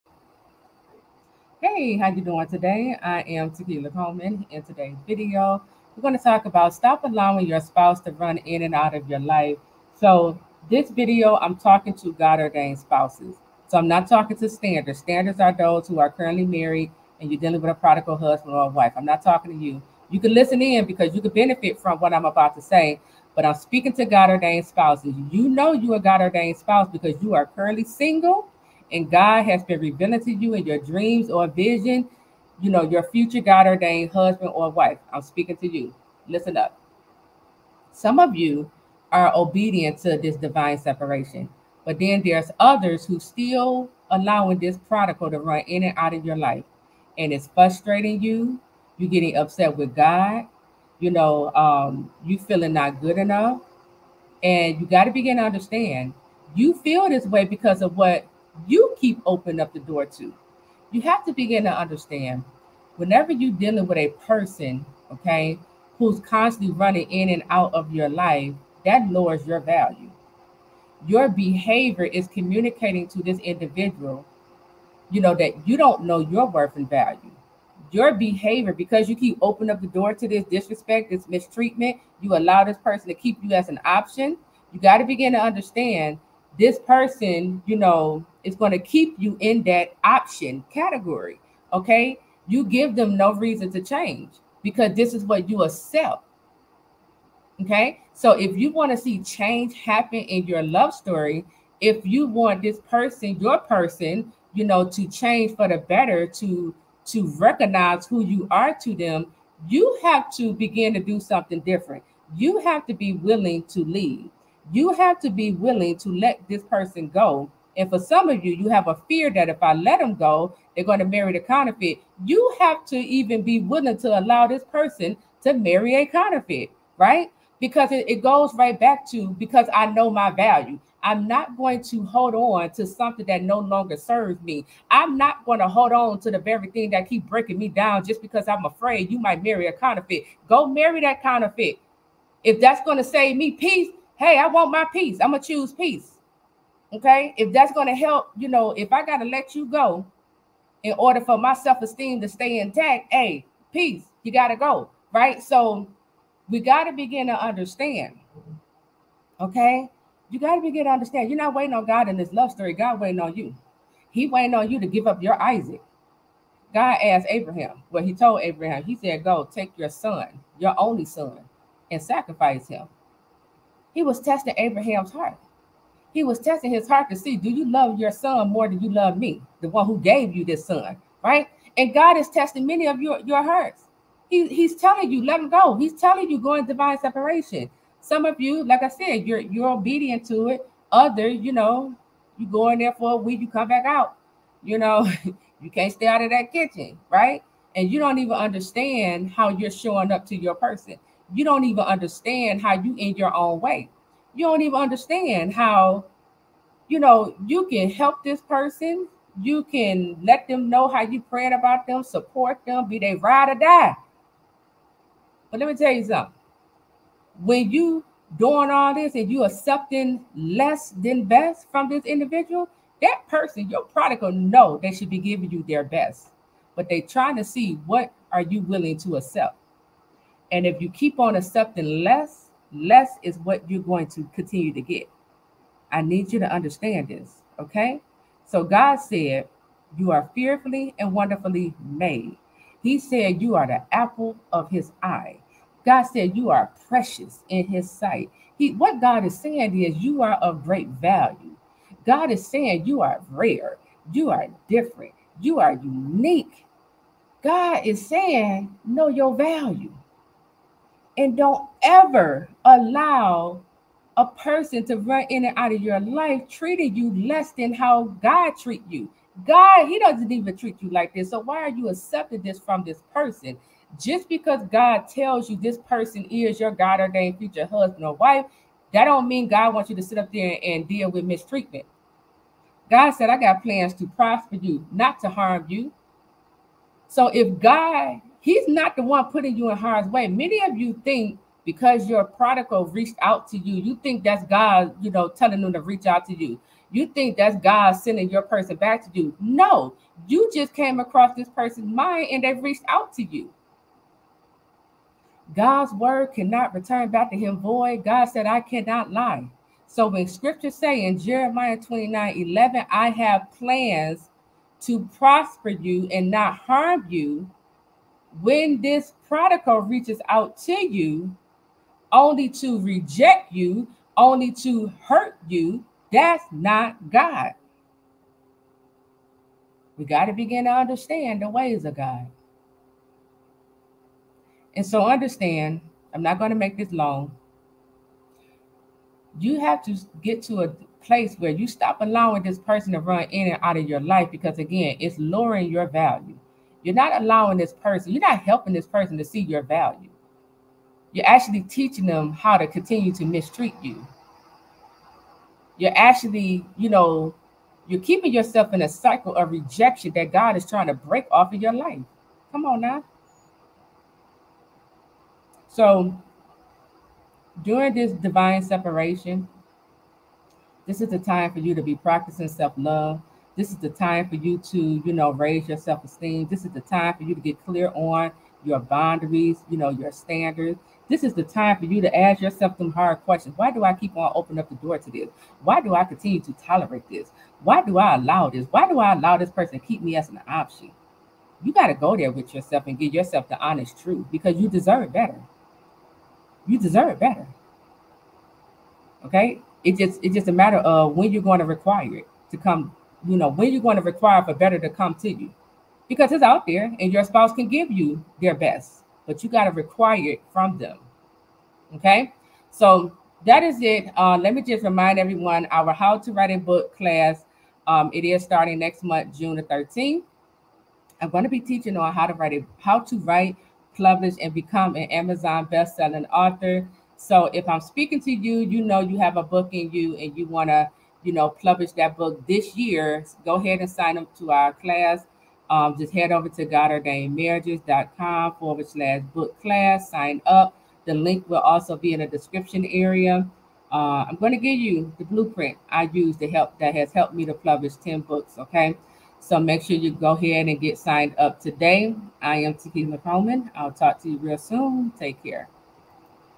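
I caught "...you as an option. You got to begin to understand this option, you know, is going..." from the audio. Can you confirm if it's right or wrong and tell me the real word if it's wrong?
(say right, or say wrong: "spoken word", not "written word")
wrong: "person", not "option".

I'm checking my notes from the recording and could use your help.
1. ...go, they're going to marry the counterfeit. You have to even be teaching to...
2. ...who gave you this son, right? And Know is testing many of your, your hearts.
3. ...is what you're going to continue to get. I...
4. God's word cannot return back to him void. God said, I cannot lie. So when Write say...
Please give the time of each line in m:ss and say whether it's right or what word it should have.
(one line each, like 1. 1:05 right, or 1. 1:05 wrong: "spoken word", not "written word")
1. 2:00 wrong: "willing", not "teaching"
2. 2:59 wrong: "God", not "Know"
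3. 3:53 right
4. 5:05 wrong: "Scripture", not "Write".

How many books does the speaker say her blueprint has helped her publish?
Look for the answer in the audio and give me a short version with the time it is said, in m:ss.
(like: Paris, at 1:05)
10, at 7:27.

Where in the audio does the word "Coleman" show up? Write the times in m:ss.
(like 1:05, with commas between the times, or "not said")
0:03, 7:33.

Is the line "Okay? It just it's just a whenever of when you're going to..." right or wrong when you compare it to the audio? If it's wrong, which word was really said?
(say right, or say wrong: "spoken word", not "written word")
wrong: "matter", not "whenever".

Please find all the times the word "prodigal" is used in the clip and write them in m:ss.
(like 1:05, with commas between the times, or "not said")
0:17, 0:44, 3:43, 4:52, 5:19.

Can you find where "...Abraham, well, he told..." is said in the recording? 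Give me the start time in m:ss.
2:47.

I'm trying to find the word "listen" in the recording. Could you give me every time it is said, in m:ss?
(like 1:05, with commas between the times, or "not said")
0:20, 0:36.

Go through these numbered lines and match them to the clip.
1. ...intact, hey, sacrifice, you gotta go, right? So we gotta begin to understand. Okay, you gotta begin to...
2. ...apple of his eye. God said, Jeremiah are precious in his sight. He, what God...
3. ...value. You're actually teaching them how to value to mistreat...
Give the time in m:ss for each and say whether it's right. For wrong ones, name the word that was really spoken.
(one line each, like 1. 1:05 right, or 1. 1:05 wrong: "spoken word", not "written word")
1. 2:32 wrong: "peace", not "sacrifice"
2. 4:03 wrong: "You", not "Jeremiah"
3. 5:49 wrong: "continue", not "value".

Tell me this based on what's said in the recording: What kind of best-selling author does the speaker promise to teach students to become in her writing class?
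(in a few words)
Amazon best-selling author.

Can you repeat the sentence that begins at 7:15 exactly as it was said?
Um, just head over to GodOrdainedMarriages.com forward slash book class, sign up.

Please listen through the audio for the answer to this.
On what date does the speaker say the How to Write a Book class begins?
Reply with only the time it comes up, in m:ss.
6:59.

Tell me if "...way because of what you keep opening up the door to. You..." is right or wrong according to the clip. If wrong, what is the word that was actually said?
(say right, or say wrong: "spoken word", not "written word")
right.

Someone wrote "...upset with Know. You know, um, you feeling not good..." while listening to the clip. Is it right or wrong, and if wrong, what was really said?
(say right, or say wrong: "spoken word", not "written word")
wrong: "God", not "Know".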